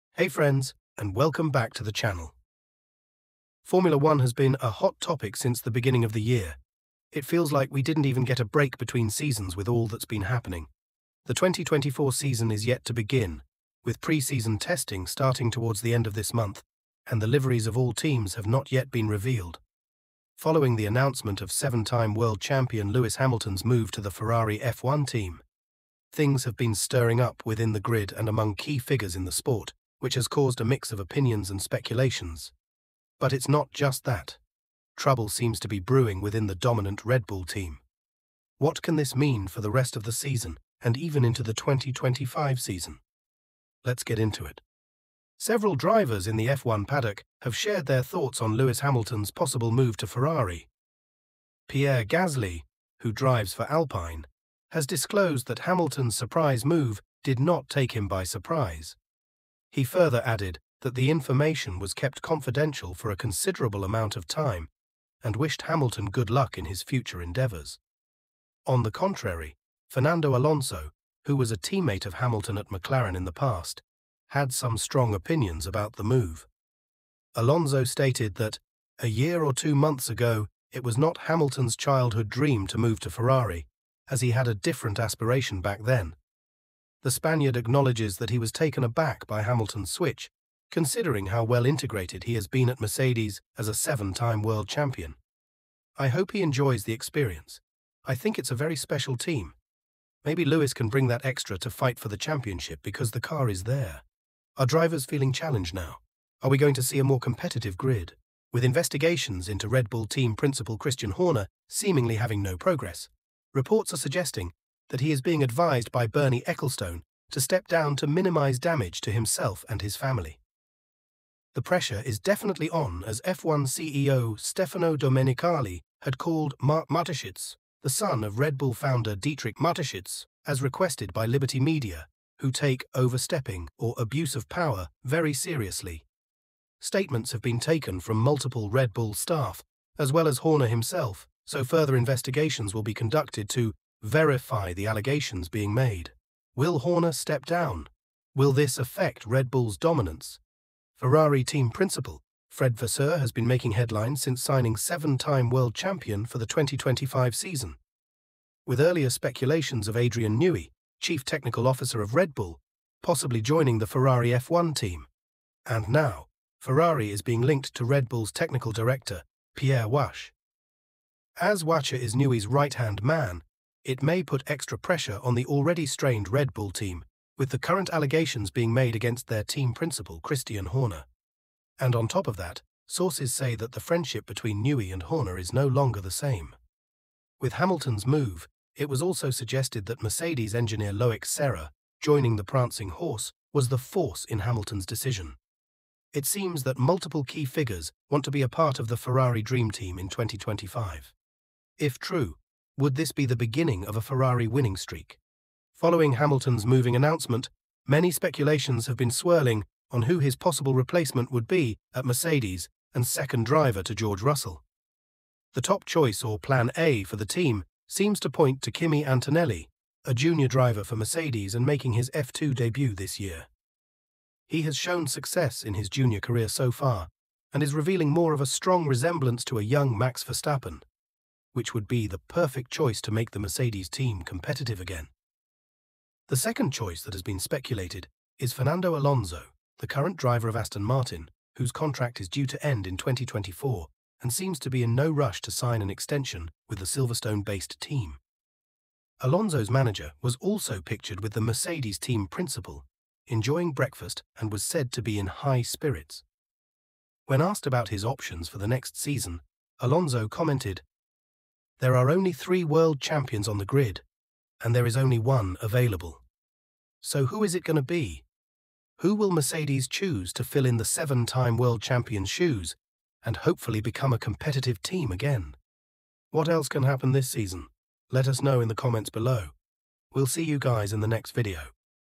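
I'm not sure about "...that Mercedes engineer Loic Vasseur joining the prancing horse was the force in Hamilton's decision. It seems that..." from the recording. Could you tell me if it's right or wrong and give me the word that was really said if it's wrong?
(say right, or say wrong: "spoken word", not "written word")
wrong: "Serra", not "Vasseur".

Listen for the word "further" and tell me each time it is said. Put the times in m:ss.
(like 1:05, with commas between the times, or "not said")
0:59, 2:21.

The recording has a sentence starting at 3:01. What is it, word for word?
And on top of that, sources say that the friendship between Newey and Horner is no longer the same.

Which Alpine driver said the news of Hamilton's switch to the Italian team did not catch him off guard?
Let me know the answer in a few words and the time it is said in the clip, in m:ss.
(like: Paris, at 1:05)
Pierre Gasly, at 0:51.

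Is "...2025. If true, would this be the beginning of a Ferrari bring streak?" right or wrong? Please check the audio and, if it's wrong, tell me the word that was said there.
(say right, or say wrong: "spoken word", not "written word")
wrong: "winning", not "bring".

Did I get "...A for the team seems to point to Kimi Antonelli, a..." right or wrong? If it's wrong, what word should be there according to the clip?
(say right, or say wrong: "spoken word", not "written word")
right.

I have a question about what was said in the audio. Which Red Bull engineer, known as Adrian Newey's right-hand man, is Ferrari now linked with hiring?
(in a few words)
Pierre Wache.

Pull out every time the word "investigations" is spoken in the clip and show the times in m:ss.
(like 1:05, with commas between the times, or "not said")
1:48, 2:21.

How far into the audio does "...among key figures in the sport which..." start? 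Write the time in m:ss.
0:28.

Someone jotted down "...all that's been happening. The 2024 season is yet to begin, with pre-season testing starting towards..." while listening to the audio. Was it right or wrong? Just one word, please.
right.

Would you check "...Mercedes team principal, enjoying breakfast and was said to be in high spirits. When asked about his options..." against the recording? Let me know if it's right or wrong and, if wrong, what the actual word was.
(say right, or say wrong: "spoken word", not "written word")
right.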